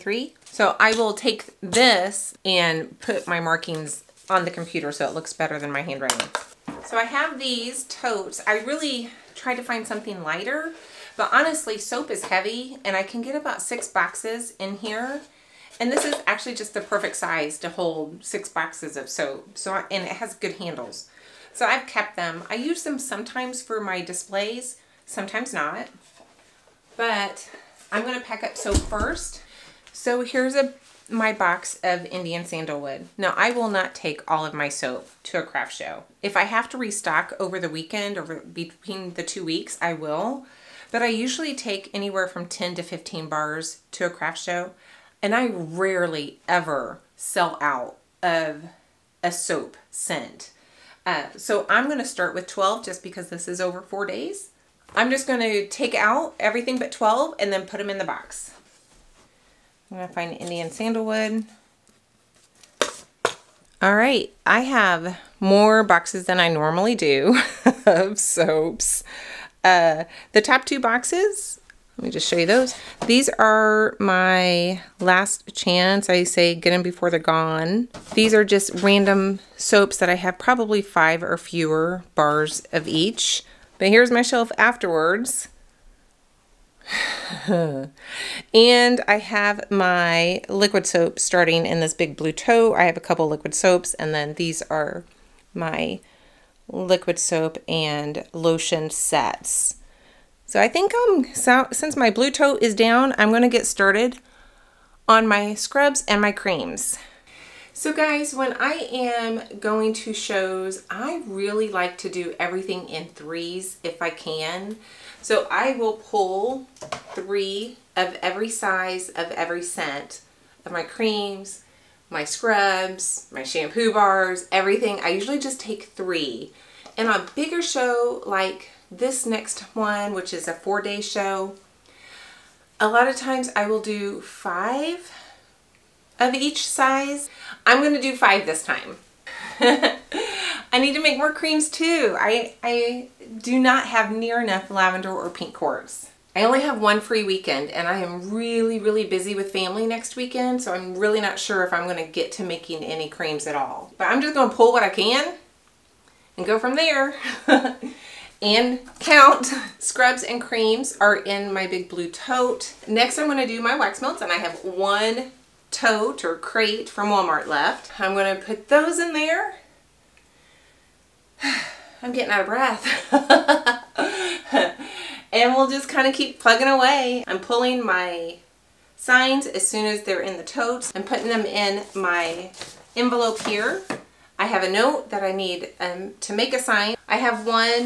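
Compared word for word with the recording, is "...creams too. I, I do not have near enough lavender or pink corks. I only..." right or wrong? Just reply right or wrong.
right.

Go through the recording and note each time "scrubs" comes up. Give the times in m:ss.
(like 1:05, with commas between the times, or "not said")
1:45, 2:02, 2:39.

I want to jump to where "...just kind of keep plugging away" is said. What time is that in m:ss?
2:55.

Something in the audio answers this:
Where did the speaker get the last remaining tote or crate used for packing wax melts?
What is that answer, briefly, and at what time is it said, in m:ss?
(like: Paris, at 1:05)
Walmart, at 2:47.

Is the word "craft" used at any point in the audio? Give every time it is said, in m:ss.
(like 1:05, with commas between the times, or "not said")
0:35, 0:44.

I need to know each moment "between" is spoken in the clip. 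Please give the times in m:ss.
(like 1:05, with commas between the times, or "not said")
0:38.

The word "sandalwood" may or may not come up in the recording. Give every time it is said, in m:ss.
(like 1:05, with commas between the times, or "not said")
0:32, 1:00.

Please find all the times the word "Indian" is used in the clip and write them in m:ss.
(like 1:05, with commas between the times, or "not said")
0:32, 1:00.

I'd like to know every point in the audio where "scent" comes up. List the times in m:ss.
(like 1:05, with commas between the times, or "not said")
0:49, 1:59.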